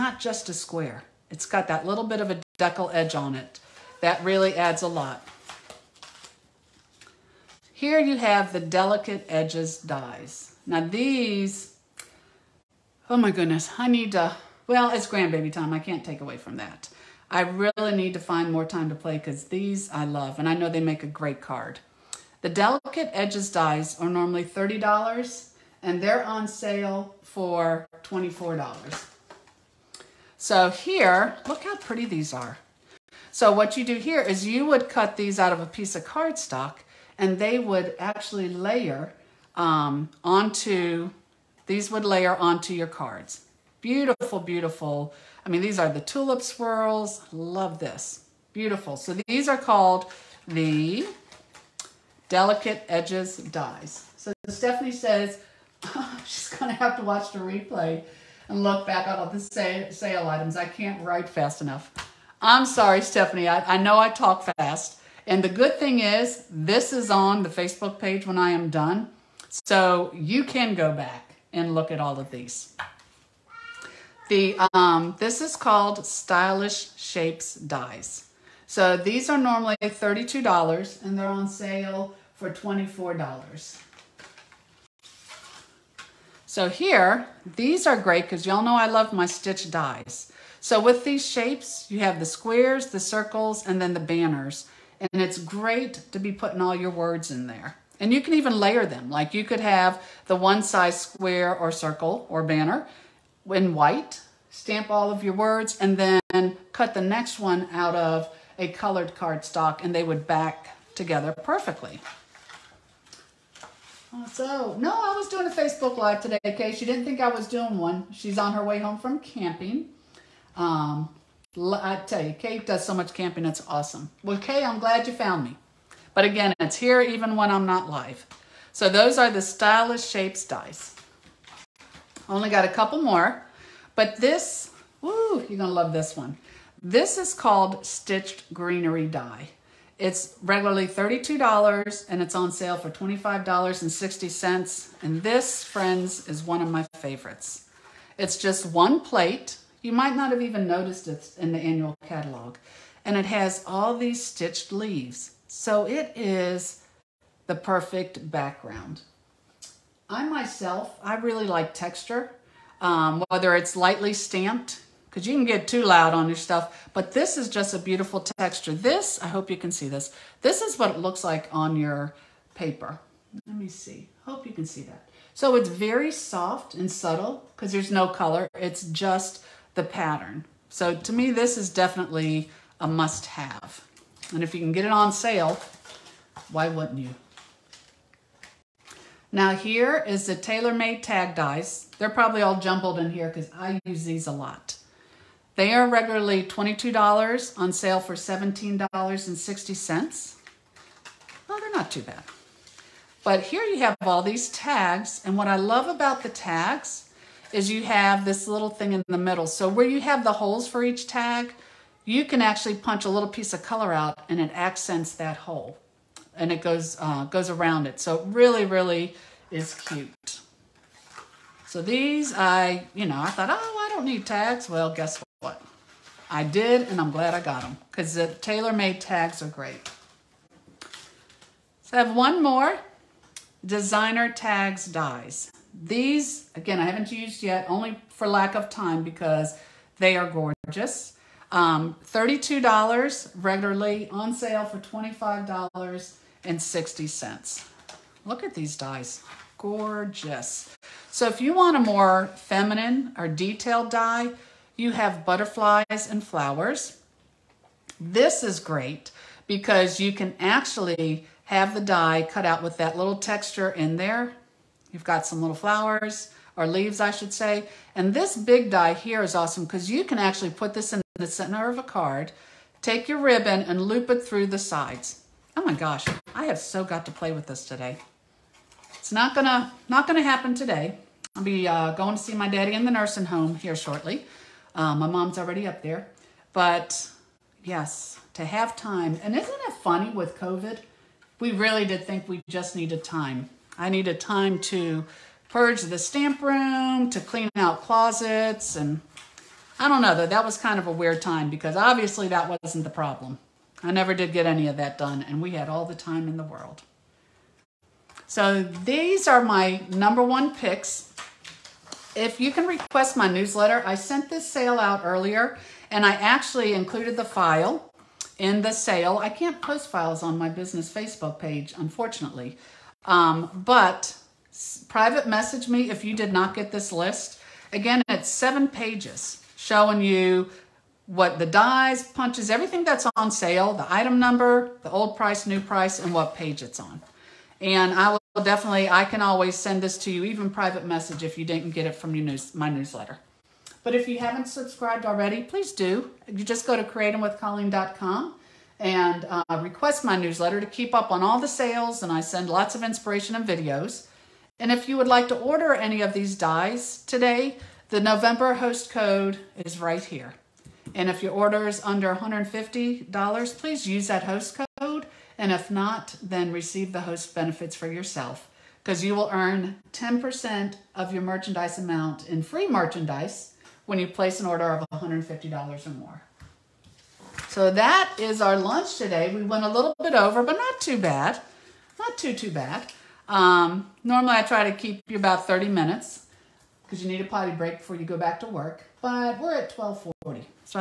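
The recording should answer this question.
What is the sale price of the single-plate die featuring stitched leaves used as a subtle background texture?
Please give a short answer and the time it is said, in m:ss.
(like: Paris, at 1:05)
$25.60, at 2:22.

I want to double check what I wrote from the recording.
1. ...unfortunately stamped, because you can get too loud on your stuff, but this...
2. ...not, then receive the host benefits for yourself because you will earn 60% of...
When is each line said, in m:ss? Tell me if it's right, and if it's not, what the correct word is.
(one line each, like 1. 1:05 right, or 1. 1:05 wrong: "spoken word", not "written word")
1. 2:43 wrong: "lightly", not "unfortunately"
2. 6:05 wrong: "10", not "60".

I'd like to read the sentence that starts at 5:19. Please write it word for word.
I can't post files on my business Facebook page, unfortunately.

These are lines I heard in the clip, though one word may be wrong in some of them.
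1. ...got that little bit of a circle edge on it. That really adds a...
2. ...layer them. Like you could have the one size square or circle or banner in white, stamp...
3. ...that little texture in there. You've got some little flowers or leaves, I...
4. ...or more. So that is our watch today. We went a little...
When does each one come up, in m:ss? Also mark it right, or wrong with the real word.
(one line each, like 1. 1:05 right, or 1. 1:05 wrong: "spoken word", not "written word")
1. 0:01 wrong: "deckle", not "circle"
2. 1:38 right
3. 4:22 right
4. 6:15 wrong: "lunch", not "watch".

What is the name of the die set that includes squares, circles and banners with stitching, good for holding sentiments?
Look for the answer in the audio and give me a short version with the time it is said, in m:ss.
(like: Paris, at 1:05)
Stylish Shapes Dies, at 1:16.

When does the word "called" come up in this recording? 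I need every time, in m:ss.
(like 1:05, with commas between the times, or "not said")
0:49, 1:15, 2:17.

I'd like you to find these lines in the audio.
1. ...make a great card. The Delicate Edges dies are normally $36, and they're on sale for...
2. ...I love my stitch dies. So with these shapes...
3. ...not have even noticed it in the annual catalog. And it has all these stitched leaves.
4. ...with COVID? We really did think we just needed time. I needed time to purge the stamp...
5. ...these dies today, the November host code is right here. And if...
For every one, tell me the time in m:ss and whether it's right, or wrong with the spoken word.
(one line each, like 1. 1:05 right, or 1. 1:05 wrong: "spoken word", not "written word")
1. 0:20 wrong: "30", not "36"
2. 1:28 right
3. 2:30 right
4. 4:50 right
5. 5:56 right.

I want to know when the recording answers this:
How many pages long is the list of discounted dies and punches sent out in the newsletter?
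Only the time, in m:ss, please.
5:28.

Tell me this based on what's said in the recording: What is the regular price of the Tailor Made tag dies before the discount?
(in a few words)
$22.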